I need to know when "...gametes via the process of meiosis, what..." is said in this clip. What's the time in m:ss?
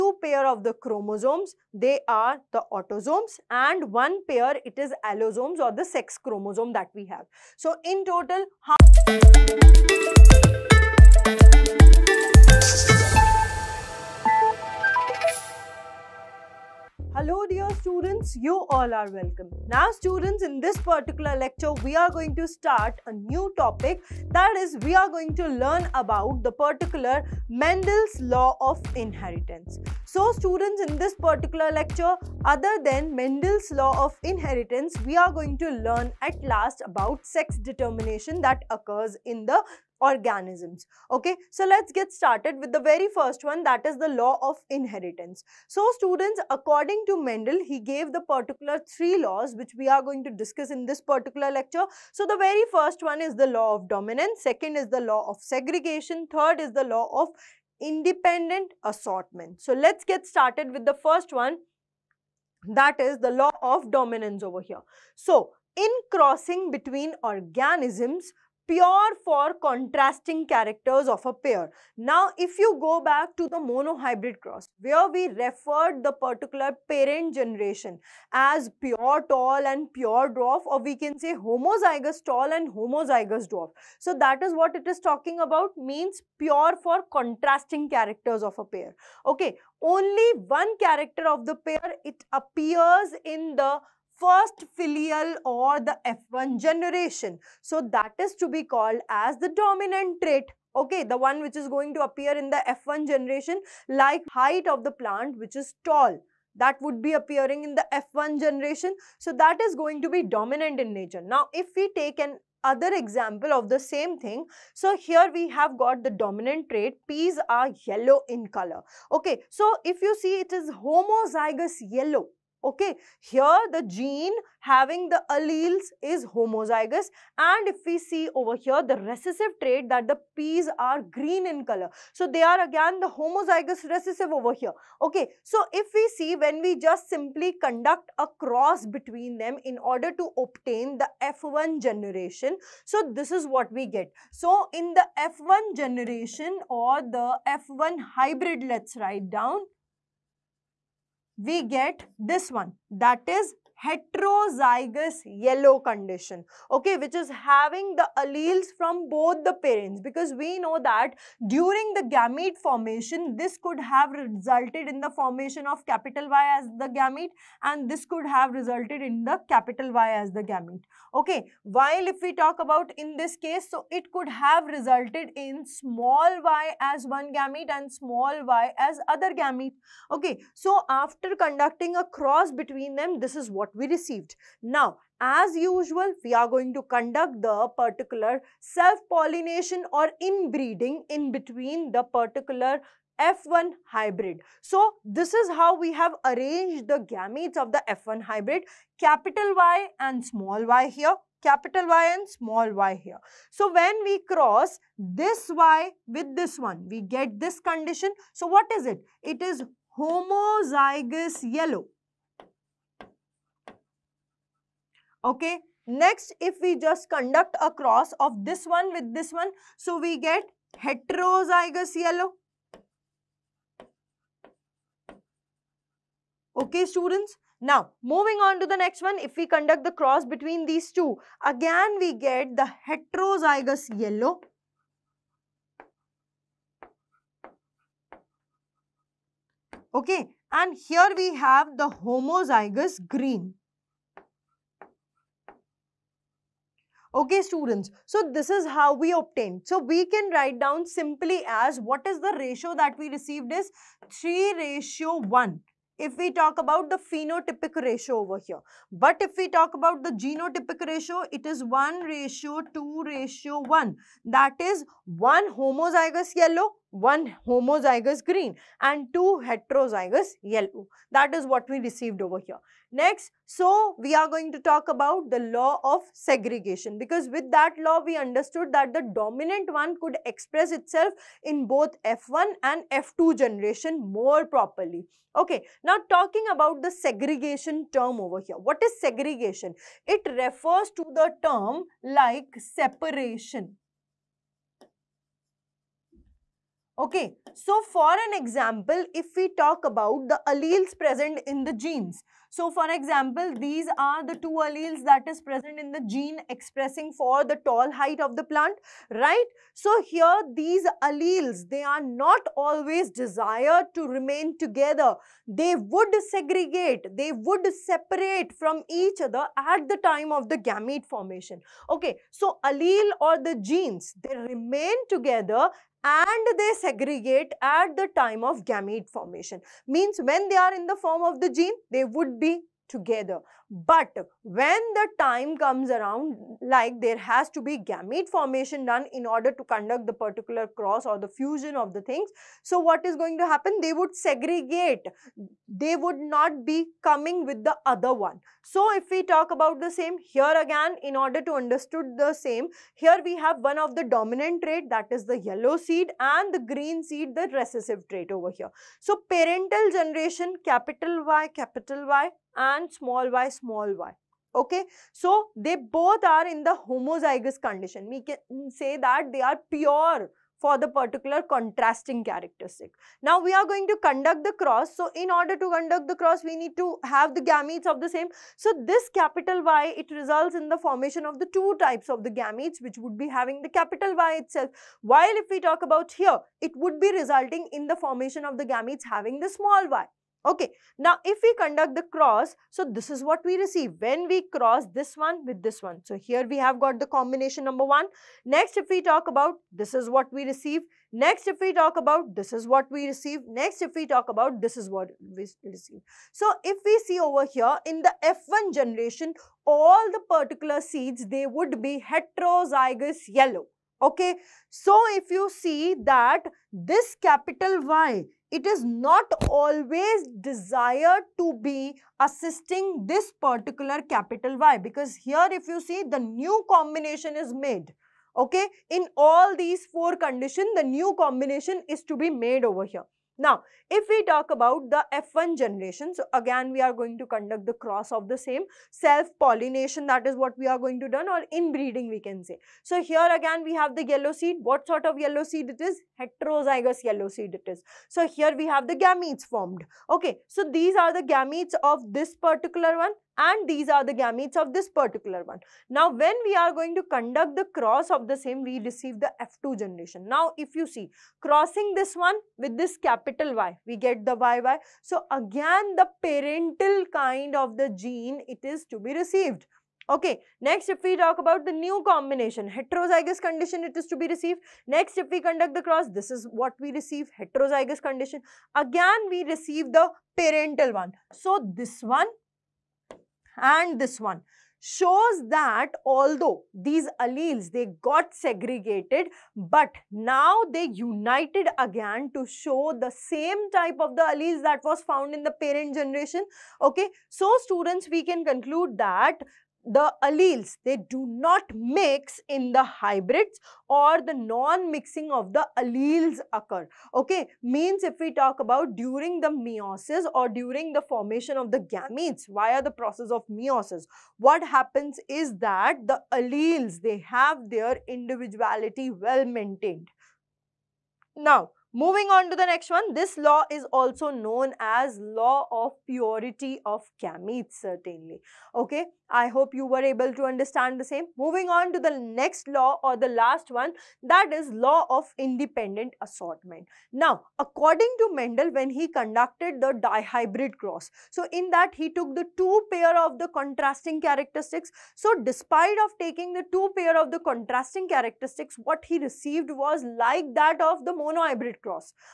8:31.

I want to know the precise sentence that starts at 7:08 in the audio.
Okay, in all these four conditions, the new combination is to be made over here.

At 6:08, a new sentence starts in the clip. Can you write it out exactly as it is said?
We can mm, say that they are pure for the particular contrasting characteristic.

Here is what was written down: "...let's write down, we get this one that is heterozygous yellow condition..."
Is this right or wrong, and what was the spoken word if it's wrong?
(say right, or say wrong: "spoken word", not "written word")
right.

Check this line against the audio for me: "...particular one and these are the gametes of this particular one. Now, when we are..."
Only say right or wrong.
right.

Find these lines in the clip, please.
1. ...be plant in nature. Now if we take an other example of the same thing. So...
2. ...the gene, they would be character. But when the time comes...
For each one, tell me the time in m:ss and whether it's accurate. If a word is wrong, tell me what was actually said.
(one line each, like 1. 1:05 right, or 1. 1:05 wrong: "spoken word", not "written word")
1. 1:50 wrong: "dominant", not "plant"
2. 5:31 wrong: "together", not "character".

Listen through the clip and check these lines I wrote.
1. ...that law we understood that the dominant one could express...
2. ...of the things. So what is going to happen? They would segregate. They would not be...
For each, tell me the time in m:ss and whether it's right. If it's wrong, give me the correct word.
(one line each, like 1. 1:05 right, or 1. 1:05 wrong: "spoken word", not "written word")
1. 4:37 right
2. 5:41 right.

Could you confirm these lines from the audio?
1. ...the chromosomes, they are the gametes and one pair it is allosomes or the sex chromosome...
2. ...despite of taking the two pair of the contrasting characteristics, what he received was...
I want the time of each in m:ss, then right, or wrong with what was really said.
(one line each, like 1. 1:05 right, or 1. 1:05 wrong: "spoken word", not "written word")
1. 0:00 wrong: "autosomes", not "gametes"
2. 9:05 right.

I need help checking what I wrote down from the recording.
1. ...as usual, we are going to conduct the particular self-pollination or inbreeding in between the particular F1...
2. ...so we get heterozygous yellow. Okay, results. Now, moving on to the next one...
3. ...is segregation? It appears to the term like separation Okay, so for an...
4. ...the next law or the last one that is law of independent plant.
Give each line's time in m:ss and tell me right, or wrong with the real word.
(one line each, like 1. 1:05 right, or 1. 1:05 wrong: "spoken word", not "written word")
1. 3:05 right
2. 3:39 wrong: "students", not "results"
3. 4:48 wrong: "refers", not "appears"
4. 8:51 wrong: "assortment", not "plant".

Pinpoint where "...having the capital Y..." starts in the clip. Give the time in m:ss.
6:23.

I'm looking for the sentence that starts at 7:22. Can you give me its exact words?
So here again we have the yellow seed.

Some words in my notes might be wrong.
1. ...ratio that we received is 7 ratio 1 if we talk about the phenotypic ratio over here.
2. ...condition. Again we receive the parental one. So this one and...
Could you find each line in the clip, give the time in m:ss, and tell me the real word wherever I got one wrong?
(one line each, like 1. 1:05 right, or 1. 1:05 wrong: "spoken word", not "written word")
1. 4:12 wrong: "3", not "7"
2. 7:58 right.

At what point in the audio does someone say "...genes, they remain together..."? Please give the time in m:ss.
5:23.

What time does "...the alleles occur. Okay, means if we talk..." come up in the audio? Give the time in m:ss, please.
8:25.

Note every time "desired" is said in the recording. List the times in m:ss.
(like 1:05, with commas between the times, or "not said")
5:13, 7:00.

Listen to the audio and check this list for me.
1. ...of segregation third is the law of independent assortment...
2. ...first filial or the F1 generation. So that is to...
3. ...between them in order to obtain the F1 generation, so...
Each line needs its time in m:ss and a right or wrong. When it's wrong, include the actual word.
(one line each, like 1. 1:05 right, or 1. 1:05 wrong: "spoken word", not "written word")
1. 0:55 right
2. 1:34 right
3. 2:18 right.